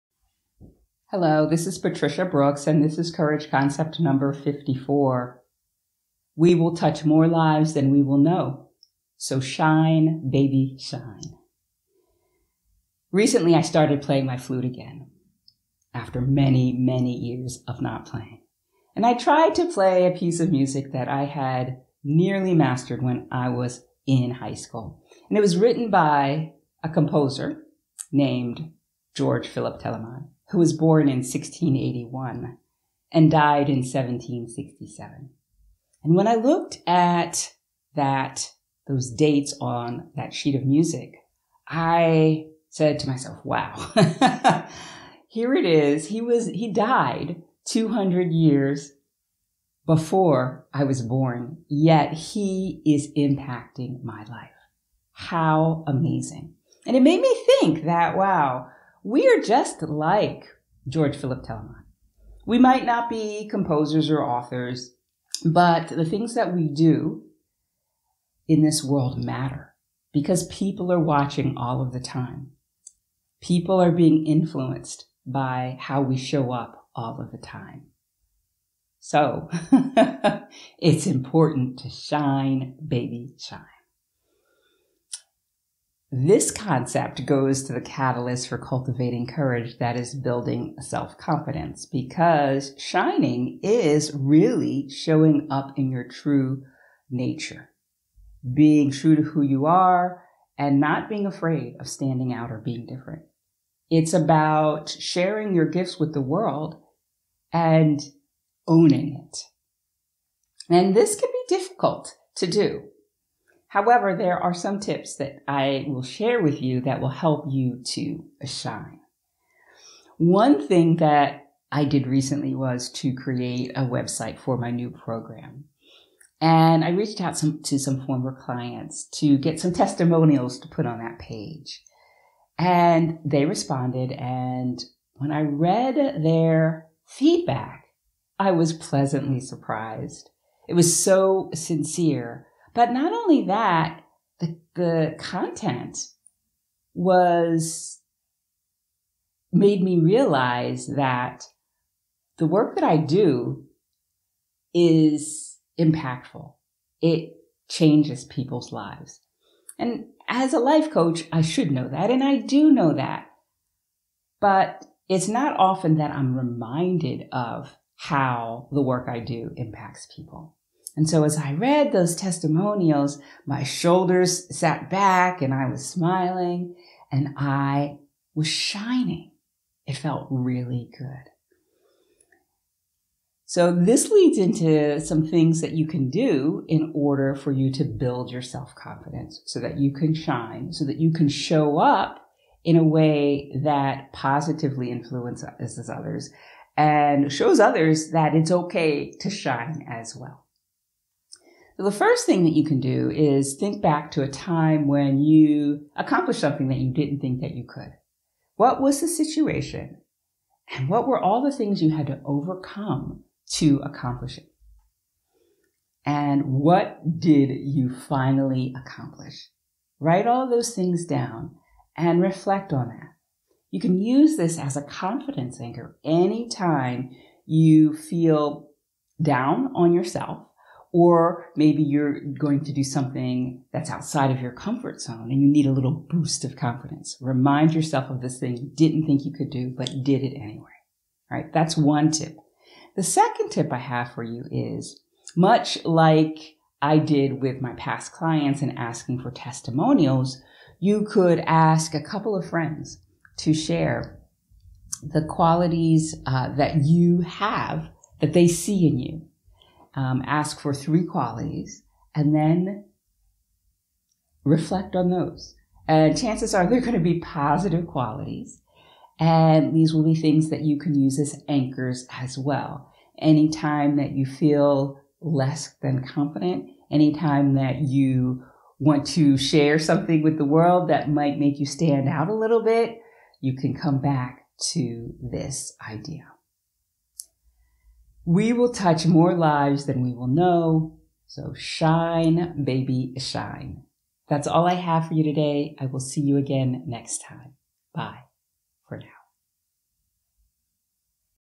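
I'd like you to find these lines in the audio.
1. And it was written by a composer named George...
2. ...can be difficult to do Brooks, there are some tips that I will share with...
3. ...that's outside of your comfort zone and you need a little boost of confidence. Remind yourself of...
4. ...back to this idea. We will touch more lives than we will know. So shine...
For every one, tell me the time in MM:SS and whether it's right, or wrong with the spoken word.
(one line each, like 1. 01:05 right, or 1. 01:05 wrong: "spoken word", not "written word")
1. 00:25 right
2. 01:51 wrong: "However", not "Brooks"
3. 03:53 right
4. 04:44 right.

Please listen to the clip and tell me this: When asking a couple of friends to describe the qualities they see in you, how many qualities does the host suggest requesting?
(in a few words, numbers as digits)
3.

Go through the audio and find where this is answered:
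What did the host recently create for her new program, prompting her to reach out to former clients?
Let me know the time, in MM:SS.
02:03.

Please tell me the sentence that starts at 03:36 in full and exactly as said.
And what did you finally accomplish?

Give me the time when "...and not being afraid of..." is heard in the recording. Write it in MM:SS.
01:40.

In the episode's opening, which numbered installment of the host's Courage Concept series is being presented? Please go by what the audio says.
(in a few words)
54.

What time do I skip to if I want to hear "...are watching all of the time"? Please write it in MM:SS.
01:10.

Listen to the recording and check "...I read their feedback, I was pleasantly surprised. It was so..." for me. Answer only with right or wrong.
right.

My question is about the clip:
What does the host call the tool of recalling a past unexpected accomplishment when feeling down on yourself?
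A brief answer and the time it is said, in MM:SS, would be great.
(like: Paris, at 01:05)
confidence anchor, at 03:44.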